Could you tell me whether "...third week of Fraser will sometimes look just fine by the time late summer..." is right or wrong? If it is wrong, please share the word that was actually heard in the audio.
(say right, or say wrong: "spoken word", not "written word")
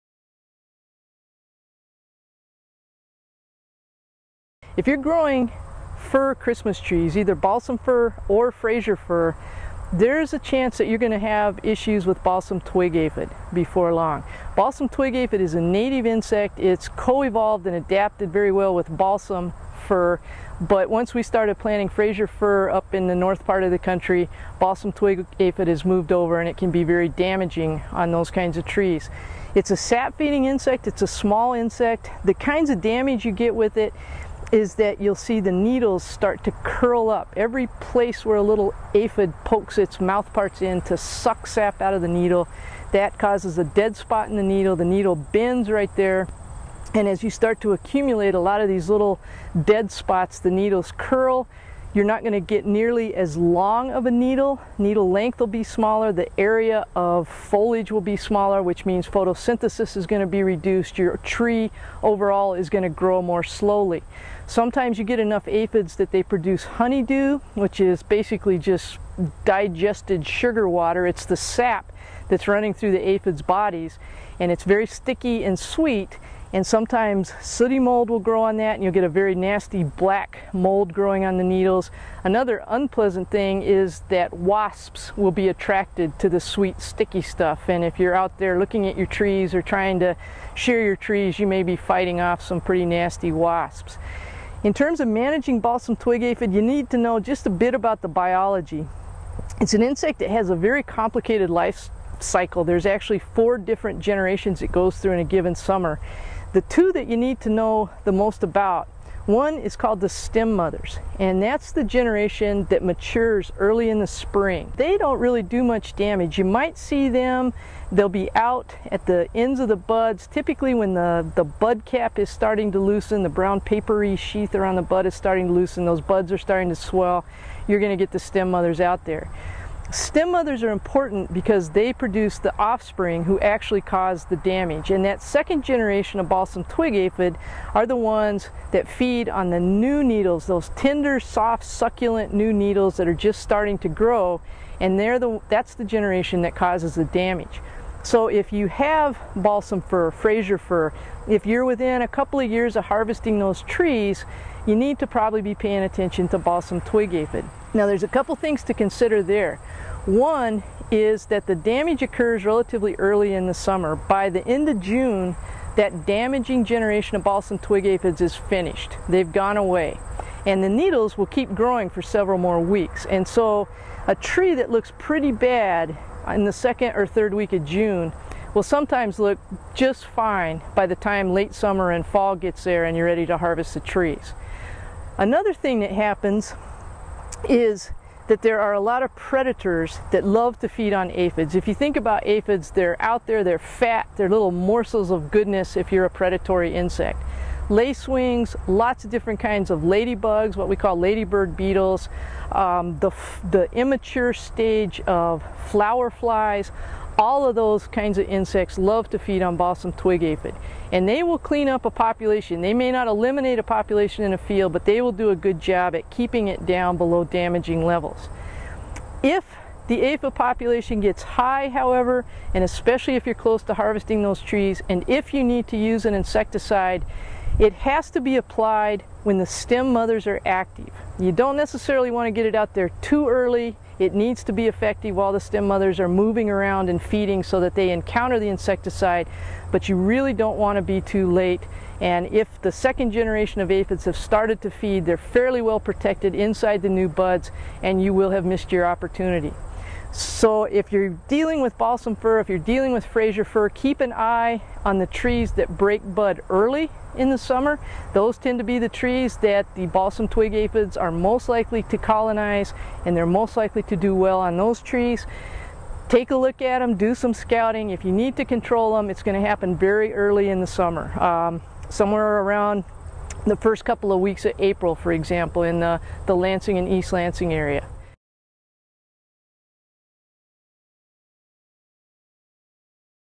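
wrong: "June", not "Fraser".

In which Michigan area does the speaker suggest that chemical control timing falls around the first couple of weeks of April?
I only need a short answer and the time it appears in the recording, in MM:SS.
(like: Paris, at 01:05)
Lansing and East Lansing, at 04:36.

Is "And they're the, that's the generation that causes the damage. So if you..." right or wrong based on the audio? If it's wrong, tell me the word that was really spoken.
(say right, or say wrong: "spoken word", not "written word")
right.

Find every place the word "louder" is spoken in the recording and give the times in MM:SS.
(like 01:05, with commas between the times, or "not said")
not said.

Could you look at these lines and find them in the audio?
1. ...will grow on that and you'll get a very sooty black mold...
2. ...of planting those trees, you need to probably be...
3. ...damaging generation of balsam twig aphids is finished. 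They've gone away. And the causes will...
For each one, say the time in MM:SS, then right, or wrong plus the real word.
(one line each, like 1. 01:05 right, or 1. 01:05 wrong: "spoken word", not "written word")
1. 01:18 wrong: "nasty", not "sooty"
2. 02:32 wrong: "harvesting", not "planting"
3. 02:46 wrong: "needles", not "causes".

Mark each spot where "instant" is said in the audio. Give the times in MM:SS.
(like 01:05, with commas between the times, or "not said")
not said.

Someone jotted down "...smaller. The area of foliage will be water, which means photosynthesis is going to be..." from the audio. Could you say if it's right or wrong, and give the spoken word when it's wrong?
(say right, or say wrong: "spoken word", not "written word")
wrong: "smaller", not "water".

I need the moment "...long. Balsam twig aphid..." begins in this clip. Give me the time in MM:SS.
00:13.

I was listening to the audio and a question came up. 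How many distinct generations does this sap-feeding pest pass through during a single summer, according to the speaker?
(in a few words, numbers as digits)
4.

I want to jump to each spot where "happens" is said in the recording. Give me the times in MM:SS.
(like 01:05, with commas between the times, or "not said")
03:05, 04:29.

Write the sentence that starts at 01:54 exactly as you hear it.
They don't really do much damage.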